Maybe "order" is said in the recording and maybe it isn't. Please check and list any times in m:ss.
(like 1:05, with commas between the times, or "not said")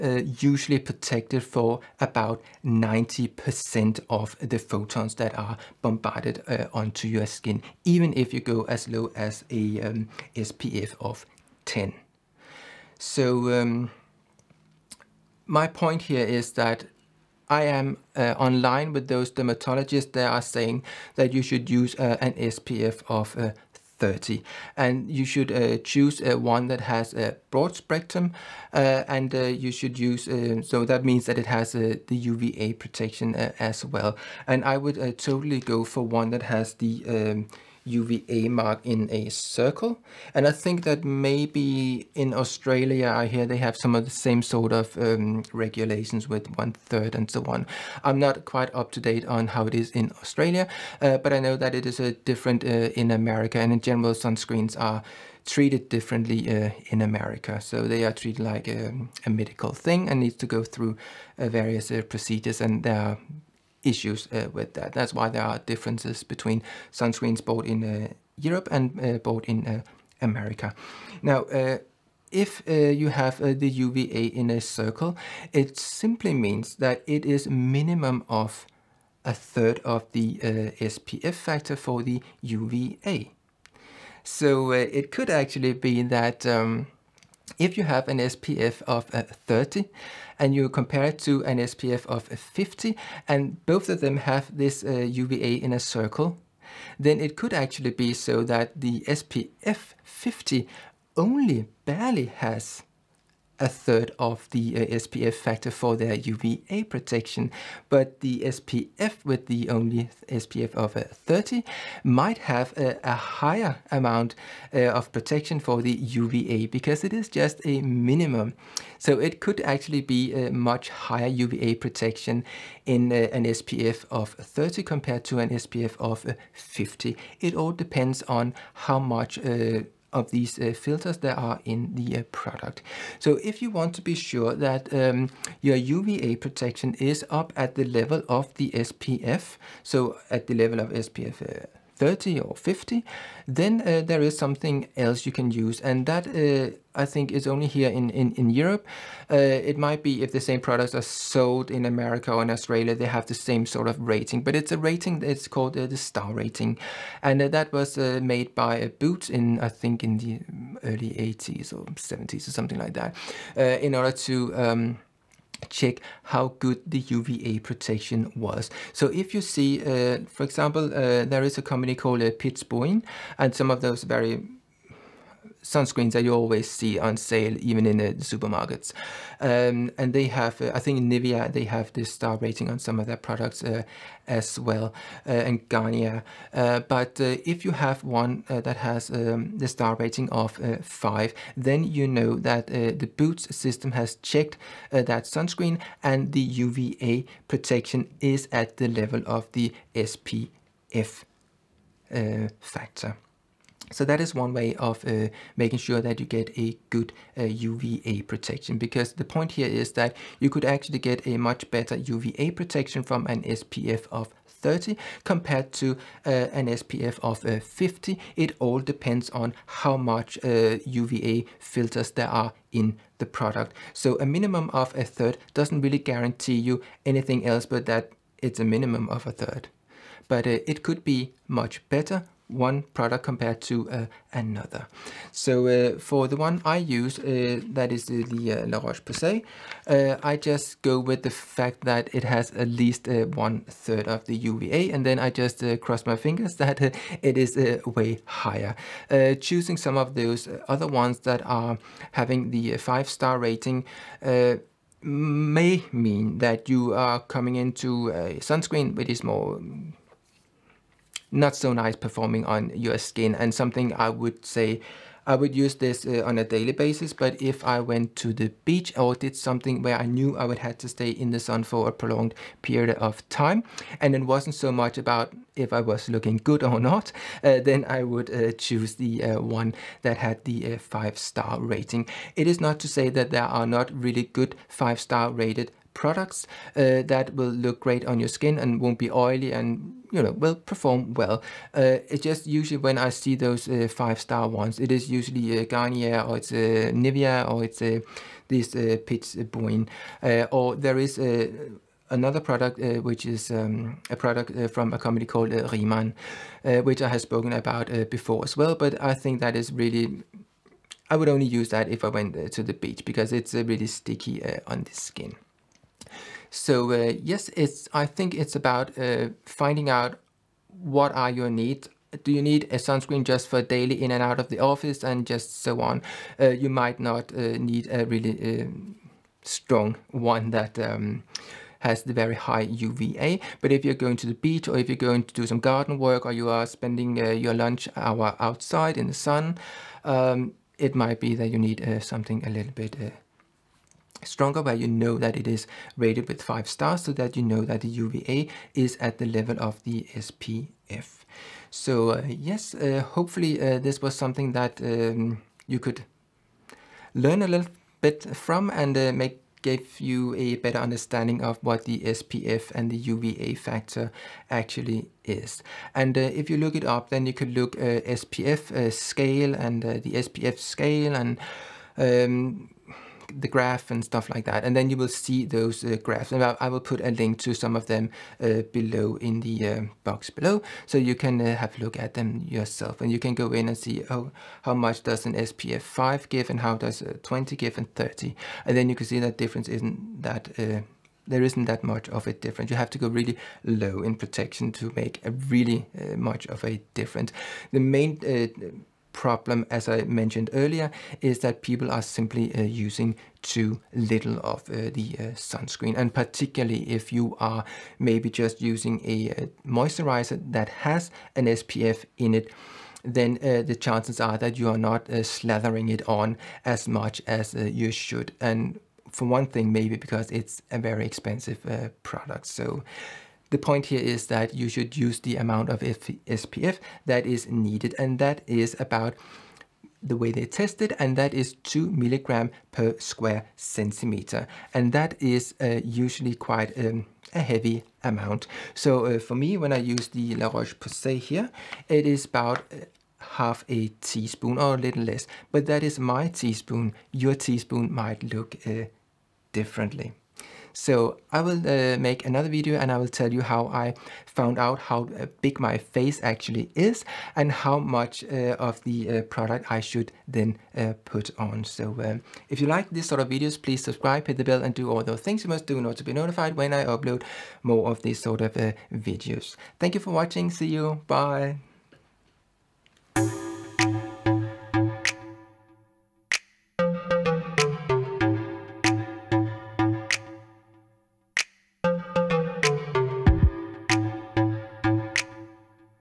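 2:43, 7:45.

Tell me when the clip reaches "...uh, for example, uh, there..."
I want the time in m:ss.
2:49.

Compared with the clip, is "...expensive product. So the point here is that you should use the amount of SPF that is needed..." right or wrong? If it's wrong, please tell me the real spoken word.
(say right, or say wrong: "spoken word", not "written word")
right.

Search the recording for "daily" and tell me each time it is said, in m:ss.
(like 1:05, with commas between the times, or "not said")
4:26, 5:23.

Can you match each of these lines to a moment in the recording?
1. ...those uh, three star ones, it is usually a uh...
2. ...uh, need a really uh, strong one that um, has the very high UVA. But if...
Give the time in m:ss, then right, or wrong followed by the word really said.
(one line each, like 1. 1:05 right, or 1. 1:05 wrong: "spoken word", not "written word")
1. 4:53 wrong: "five", not "three"
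2. 5:27 right.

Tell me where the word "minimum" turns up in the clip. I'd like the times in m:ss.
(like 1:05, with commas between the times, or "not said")
1:17, 1:57, 3:44, 3:48.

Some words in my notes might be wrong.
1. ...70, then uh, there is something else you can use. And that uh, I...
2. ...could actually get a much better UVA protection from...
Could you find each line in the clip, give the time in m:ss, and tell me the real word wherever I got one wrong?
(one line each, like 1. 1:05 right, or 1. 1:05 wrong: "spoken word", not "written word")
1. 2:22 wrong: "50", not "70"
2. 3:30 right.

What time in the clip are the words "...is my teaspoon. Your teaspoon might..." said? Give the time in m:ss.
7:25.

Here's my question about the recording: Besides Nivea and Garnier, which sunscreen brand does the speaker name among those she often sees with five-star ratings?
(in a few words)
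Piz Buin.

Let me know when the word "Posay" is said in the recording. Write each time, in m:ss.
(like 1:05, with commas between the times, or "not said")
3:58, 7:20.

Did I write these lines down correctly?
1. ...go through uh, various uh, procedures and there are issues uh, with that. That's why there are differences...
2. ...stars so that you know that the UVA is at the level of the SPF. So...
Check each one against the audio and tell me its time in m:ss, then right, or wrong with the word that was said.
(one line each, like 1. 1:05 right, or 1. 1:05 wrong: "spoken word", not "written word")
1. 1:00 right
2. 5:46 right.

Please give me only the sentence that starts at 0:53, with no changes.
And in general, sunscreens are treated differently uh, in America.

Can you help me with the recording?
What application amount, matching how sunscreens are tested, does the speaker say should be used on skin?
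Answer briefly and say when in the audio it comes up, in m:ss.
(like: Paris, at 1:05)
2 milligrams per square centimeter, at 7:11.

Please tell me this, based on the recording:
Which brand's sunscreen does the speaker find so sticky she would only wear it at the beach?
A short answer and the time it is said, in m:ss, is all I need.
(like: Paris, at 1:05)
Riemann, at 5:05.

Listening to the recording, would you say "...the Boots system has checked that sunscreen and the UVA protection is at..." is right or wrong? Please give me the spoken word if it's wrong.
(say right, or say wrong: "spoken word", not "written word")
right.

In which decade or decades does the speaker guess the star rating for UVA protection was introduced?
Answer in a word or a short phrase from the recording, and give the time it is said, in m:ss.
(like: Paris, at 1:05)
early 80s or 70s, at 2:40.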